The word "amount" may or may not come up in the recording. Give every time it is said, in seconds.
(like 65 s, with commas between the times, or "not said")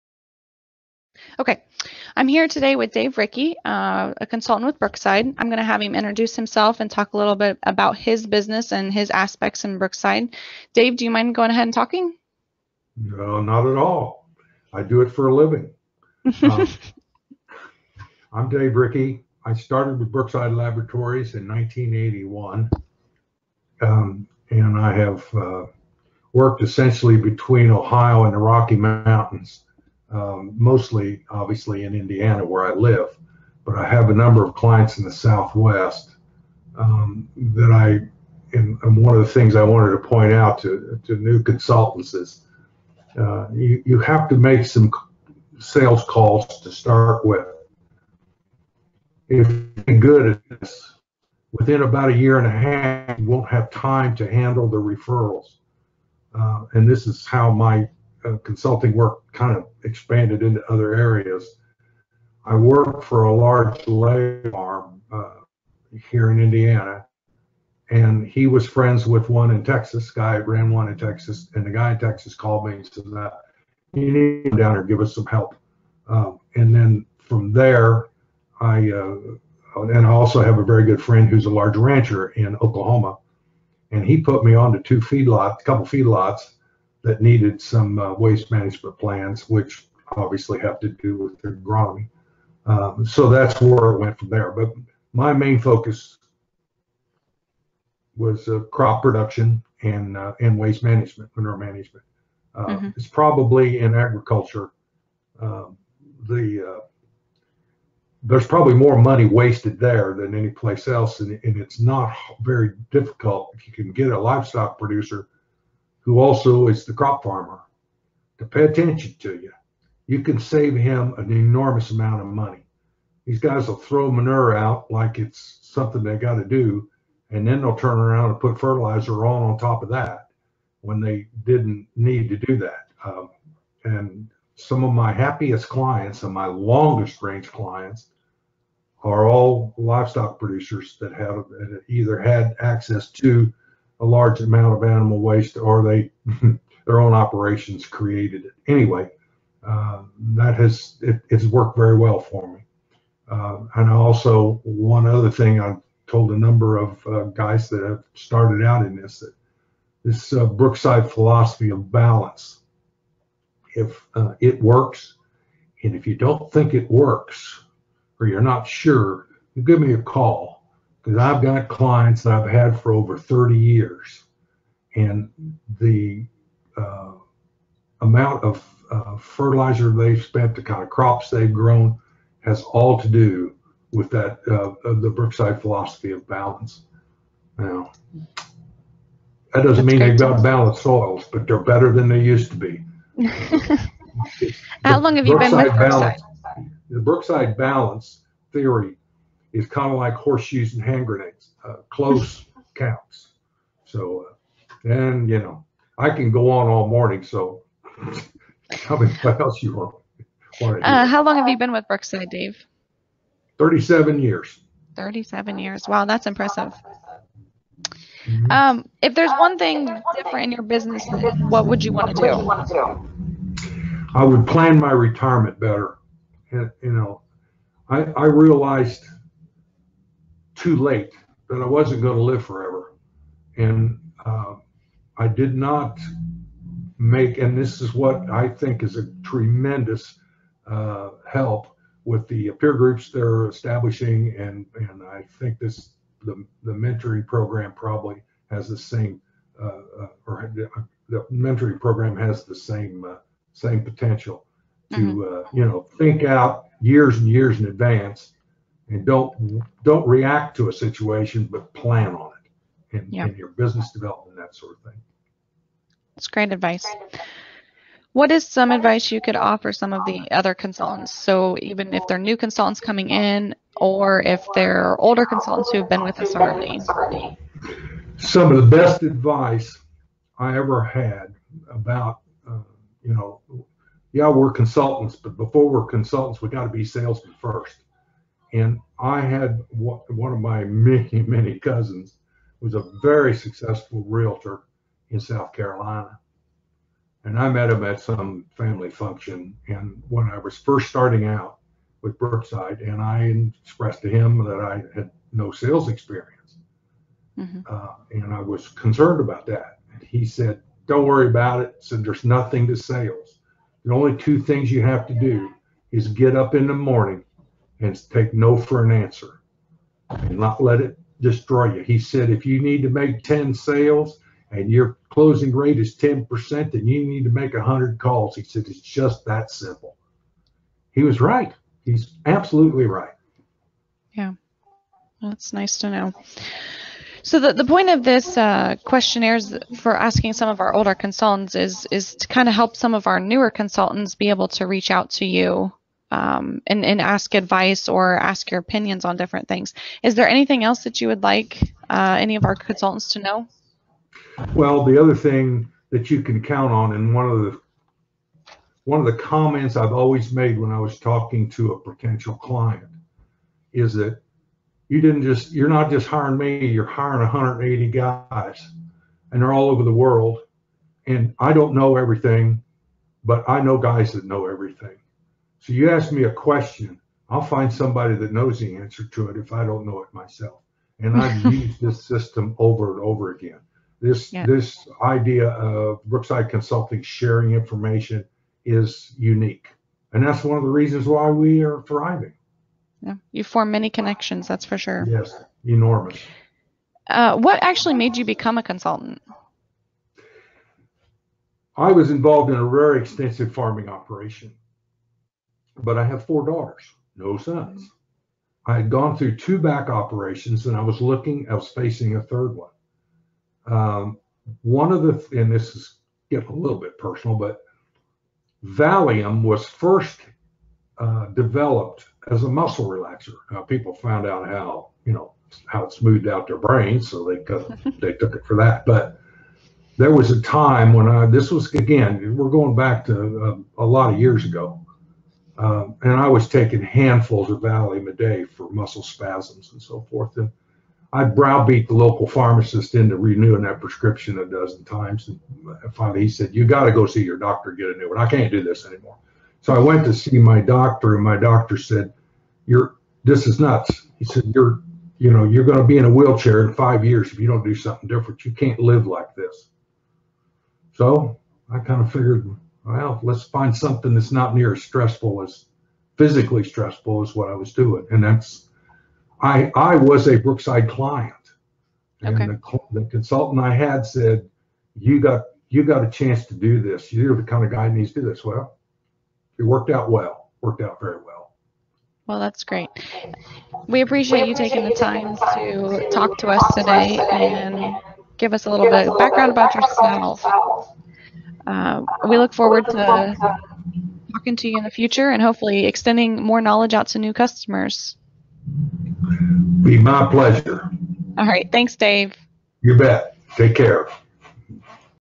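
121 s, 144 s, 178 s.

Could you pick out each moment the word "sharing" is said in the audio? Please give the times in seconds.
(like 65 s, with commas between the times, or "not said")
387 s.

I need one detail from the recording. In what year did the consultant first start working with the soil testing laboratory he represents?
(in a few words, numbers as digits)
1981.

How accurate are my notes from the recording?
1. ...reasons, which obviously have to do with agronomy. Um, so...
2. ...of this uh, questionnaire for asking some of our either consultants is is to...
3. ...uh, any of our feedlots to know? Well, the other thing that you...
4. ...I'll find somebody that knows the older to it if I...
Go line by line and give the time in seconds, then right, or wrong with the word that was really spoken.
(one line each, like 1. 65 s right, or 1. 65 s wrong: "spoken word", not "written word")
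1. 88 s wrong: "plans", not "reasons"
2. 337 s wrong: "older", not "either"
3. 351 s wrong: "consultants", not "feedlots"
4. 377 s wrong: "answer", not "older".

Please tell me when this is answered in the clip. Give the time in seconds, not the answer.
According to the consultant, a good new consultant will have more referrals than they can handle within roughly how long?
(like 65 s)
51 s.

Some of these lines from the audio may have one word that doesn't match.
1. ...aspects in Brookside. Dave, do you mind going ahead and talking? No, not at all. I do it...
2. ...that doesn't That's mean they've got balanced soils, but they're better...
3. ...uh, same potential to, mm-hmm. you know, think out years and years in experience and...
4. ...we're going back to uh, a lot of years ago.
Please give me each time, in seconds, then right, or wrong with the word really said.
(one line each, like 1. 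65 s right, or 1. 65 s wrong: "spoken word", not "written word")
1. 9 s right
2. 189 s right
3. 253 s wrong: "advance", not "experience"
4. 432 s right.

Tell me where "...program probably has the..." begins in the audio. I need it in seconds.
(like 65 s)
247 s.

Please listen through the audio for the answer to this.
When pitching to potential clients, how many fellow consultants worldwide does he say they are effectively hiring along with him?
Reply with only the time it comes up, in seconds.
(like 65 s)
367 s.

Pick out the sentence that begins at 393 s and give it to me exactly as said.
Yeah, you form many connections, that's for sure.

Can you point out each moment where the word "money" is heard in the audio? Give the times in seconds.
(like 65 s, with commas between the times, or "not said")
109 s, 122 s.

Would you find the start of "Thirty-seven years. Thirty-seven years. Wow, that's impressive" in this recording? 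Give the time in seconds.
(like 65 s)
213 s.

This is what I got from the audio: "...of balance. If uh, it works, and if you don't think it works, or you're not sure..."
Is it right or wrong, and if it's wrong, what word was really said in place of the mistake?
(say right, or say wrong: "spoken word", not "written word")
right.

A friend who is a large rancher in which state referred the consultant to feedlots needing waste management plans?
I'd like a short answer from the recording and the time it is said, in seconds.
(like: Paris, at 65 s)
Oklahoma, at 82 s.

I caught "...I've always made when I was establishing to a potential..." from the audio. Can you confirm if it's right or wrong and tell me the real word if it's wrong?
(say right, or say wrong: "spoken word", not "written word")
wrong: "talking", not "establishing".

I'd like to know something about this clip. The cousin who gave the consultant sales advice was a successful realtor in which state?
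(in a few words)
South Carolina.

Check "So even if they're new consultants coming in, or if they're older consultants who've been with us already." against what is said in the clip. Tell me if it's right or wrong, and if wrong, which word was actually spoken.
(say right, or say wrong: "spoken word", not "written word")
right.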